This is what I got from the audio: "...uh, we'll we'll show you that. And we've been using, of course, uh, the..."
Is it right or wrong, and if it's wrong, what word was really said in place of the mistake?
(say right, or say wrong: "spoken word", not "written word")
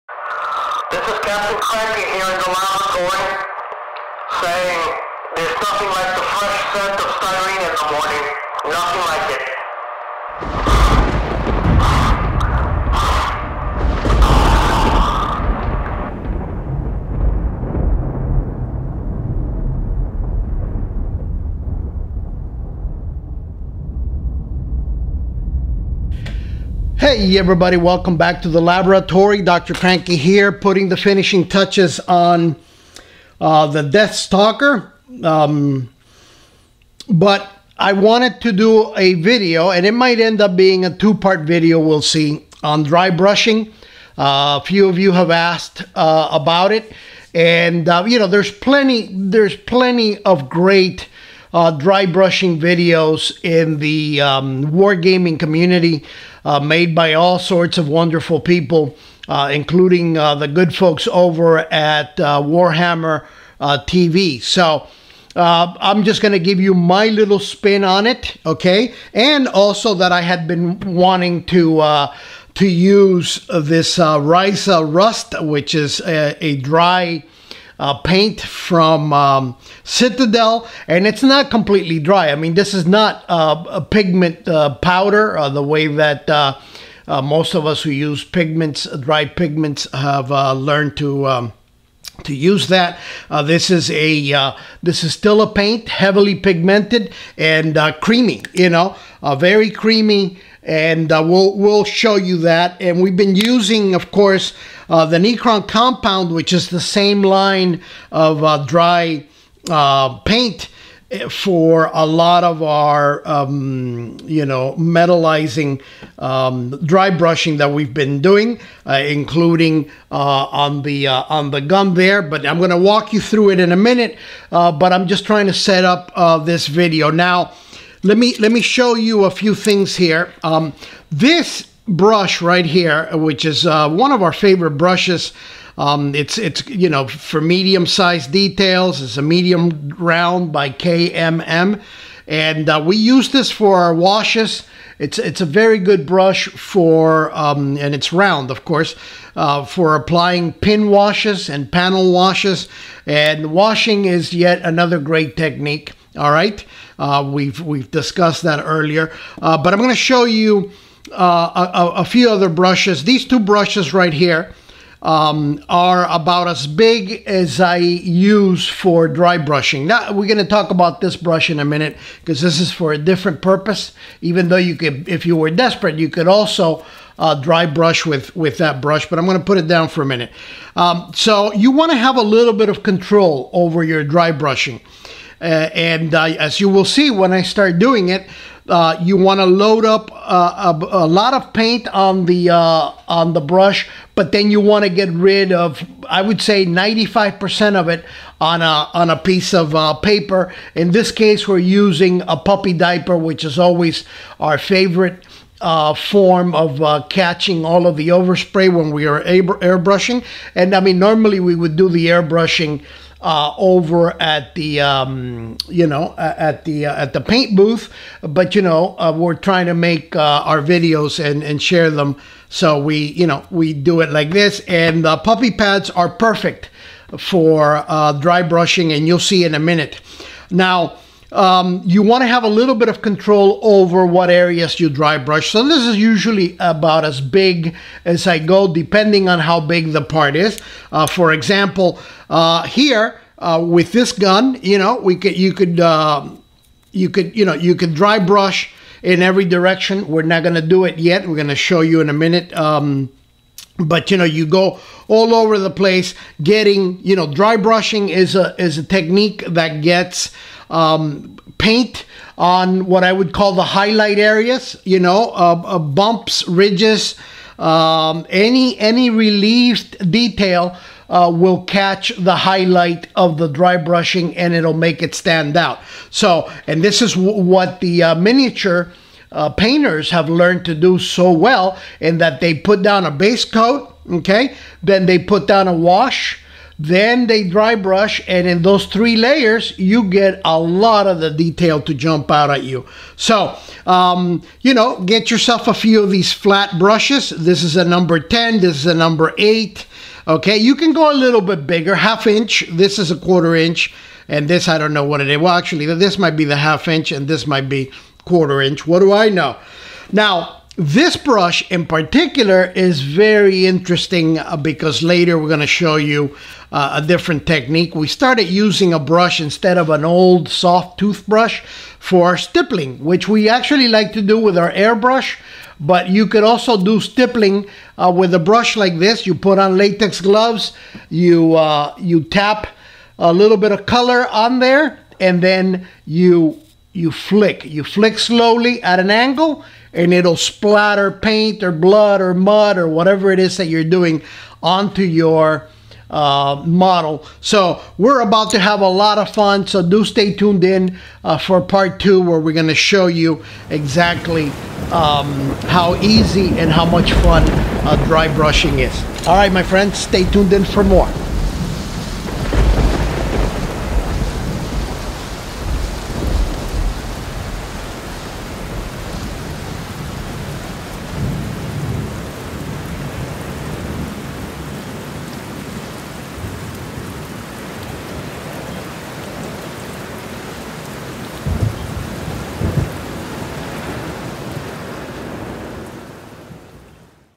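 right.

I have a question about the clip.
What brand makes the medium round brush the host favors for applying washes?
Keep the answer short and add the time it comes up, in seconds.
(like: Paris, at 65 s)
KMM, at 140 s.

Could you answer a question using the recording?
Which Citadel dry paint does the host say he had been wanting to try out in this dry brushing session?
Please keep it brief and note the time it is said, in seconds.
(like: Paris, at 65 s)
Ryza Rust, at 74 s.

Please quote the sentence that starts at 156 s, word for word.
All right, uh, we've we've discussed that earlier, uh, but I'm going to show you.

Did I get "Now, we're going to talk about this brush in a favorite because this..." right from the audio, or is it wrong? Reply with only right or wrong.
wrong.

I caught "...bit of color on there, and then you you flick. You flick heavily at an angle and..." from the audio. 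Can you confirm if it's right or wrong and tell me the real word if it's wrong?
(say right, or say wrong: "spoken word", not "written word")
wrong: "slowly", not "heavily".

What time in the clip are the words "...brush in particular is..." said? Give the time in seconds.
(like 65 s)
311 s.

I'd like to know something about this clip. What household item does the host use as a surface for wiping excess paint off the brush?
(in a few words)
puppy diaper.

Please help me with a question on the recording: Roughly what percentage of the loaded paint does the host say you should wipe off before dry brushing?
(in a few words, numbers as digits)
95%.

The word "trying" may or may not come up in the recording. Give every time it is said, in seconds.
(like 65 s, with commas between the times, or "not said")
125 s, 219 s.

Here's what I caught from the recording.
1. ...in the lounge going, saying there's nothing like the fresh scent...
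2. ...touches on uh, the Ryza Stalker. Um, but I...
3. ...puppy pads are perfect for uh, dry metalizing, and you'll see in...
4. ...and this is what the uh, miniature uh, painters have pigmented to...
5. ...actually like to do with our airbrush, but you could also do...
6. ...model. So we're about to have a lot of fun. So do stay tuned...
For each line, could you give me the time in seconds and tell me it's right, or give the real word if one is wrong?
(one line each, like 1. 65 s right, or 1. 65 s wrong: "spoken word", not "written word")
1. 2 s right
2. 31 s wrong: "Death", not "Ryza"
3. 225 s wrong: "brushing", not "metalizing"
4. 276 s wrong: "learned", not "pigmented"
5. 323 s right
6. 346 s right.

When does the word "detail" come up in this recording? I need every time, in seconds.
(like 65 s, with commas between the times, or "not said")
138 s, 270 s, 291 s.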